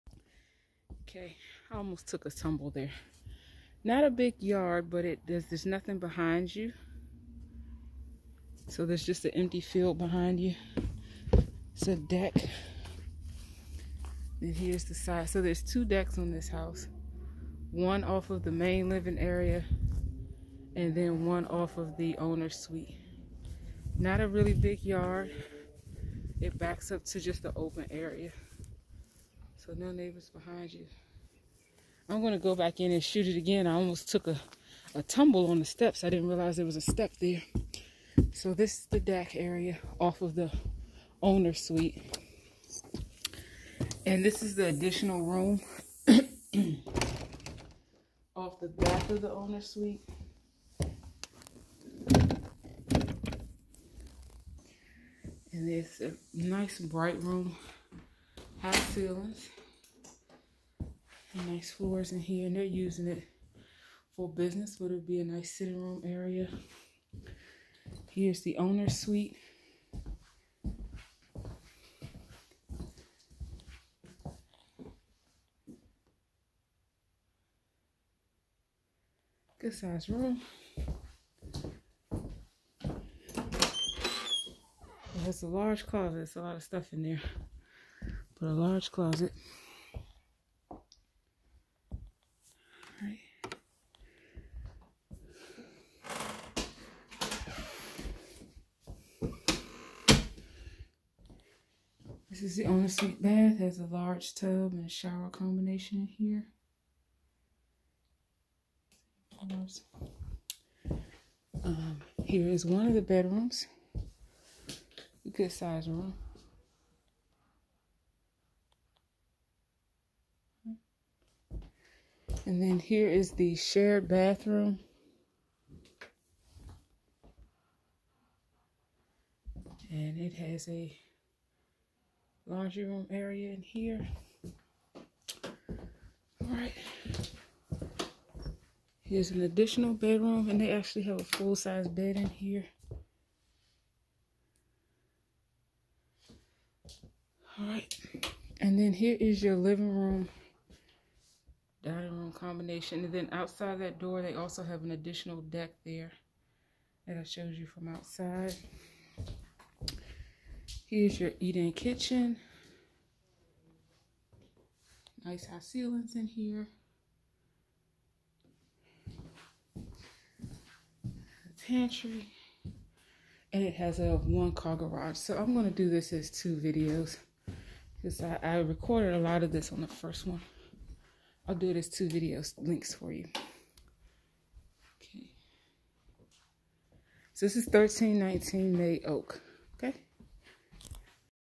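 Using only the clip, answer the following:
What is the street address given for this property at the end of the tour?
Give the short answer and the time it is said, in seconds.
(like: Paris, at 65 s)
1319 May Oak, at 187 s.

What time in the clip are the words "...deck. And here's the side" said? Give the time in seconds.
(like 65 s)
11 s.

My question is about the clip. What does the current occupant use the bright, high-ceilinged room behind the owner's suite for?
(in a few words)
Business.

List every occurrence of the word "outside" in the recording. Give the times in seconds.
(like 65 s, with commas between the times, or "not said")
153 s, 157 s.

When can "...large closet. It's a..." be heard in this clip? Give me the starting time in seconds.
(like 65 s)
85 s.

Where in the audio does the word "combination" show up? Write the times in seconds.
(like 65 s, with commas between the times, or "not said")
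105 s, 152 s.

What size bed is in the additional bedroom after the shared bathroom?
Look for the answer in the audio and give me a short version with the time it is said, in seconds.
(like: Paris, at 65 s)
Full-size, at 141 s.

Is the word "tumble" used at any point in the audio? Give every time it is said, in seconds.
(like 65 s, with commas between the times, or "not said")
2 s, 35 s.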